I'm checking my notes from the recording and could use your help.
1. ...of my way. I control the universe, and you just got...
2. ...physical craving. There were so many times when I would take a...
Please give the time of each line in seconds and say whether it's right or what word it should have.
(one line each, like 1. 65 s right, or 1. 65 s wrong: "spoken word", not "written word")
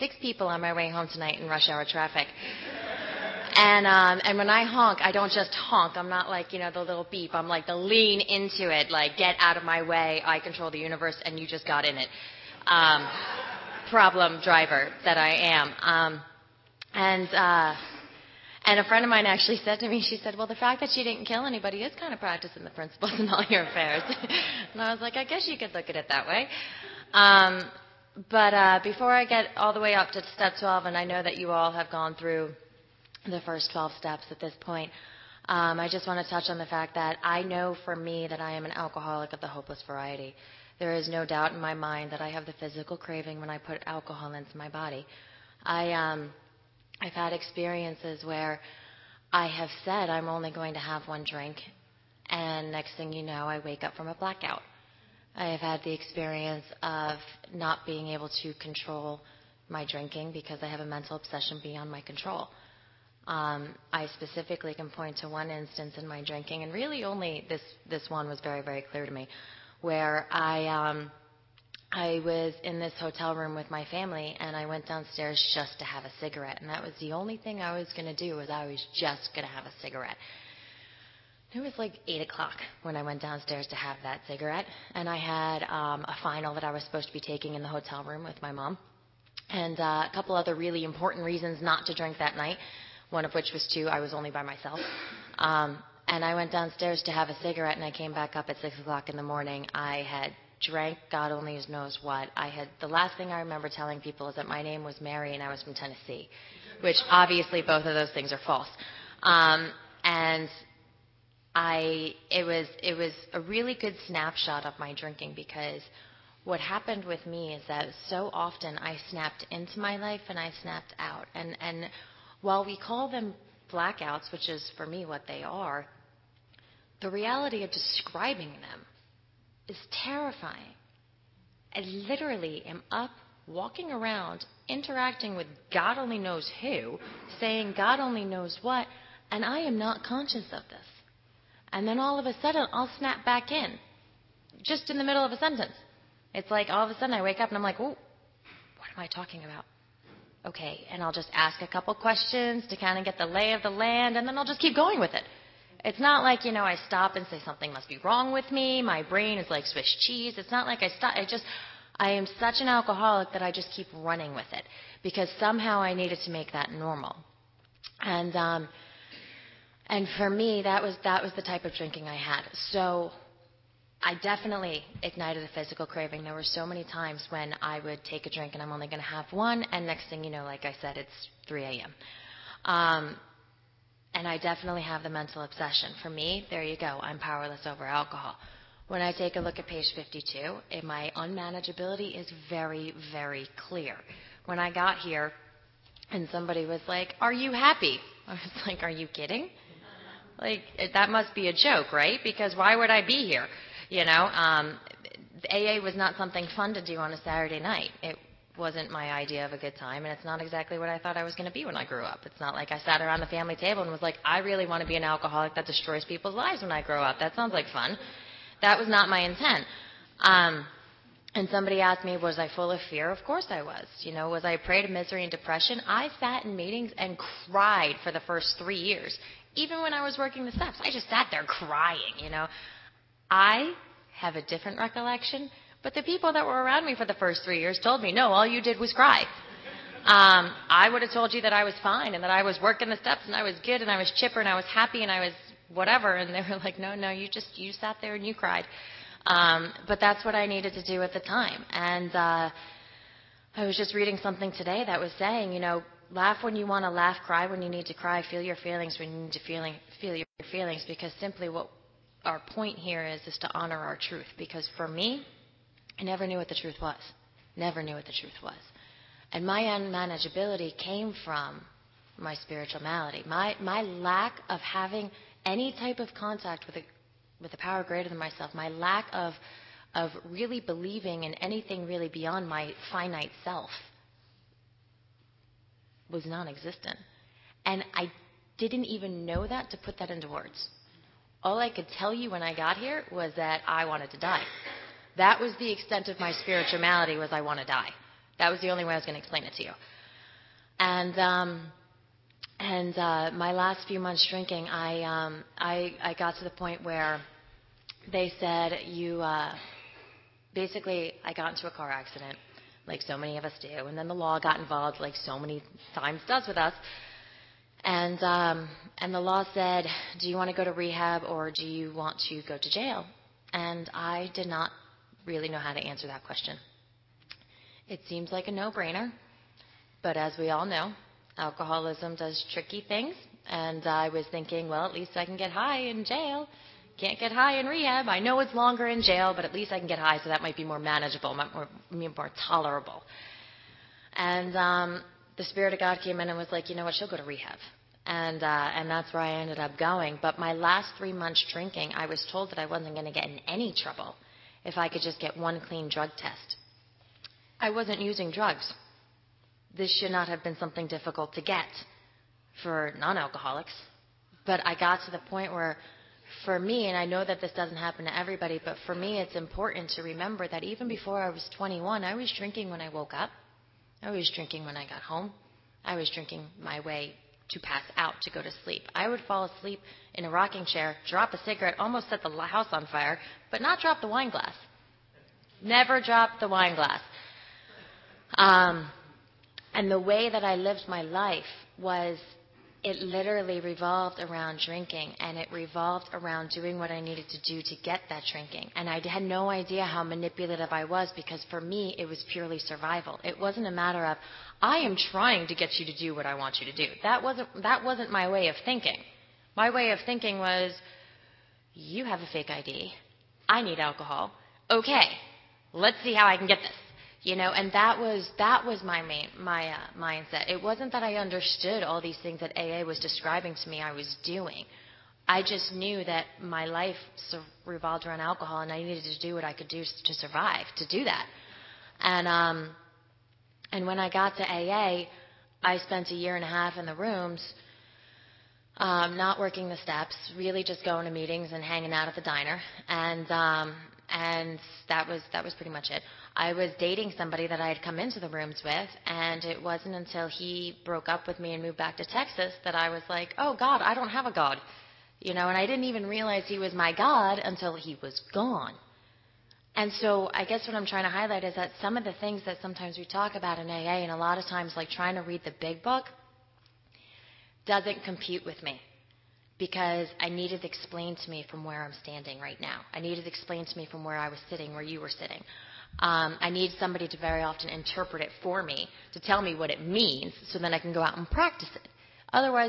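1. 9 s right
2. 175 s right.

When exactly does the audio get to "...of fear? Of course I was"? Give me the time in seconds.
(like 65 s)
222 s.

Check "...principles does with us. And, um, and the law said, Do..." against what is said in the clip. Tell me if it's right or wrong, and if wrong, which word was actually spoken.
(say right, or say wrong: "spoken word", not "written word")
wrong: "times", not "principles".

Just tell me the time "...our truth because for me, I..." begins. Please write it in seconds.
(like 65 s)
263 s.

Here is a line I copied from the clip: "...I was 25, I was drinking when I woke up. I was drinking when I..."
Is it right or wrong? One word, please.
wrong.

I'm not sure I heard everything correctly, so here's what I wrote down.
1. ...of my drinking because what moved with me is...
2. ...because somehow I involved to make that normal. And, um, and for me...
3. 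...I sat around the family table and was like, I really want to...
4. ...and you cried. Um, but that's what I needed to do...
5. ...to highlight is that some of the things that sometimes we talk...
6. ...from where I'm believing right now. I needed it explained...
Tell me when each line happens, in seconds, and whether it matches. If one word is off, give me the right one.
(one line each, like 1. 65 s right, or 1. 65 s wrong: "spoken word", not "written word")
1. 114 s wrong: "happened", not "moved"
2. 165 s wrong: "needed", not "involved"
3. 212 s right
4. 248 s right
5. 461 s right
6. 471 s wrong: "standing", not "believing".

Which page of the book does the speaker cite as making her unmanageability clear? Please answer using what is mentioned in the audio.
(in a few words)
52.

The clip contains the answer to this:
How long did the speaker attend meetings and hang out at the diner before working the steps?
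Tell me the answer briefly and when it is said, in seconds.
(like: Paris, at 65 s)
A year and a half, at 436 s.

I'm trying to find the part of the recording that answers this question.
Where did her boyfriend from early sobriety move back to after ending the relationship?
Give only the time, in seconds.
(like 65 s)
452 s.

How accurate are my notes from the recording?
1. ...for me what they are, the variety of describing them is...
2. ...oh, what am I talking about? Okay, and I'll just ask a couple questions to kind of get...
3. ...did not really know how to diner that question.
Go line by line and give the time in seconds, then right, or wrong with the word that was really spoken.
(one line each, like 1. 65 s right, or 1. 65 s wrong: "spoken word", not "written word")
1. 124 s wrong: "reality", not "variety"
2. 147 s right
3. 324 s wrong: "answer", not "diner".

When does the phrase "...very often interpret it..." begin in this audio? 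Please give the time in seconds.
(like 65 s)
477 s.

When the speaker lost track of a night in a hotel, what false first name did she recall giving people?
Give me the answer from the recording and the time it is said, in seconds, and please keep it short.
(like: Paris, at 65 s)
Mary, at 104 s.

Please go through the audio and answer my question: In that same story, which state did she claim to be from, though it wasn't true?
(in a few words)
Tennessee.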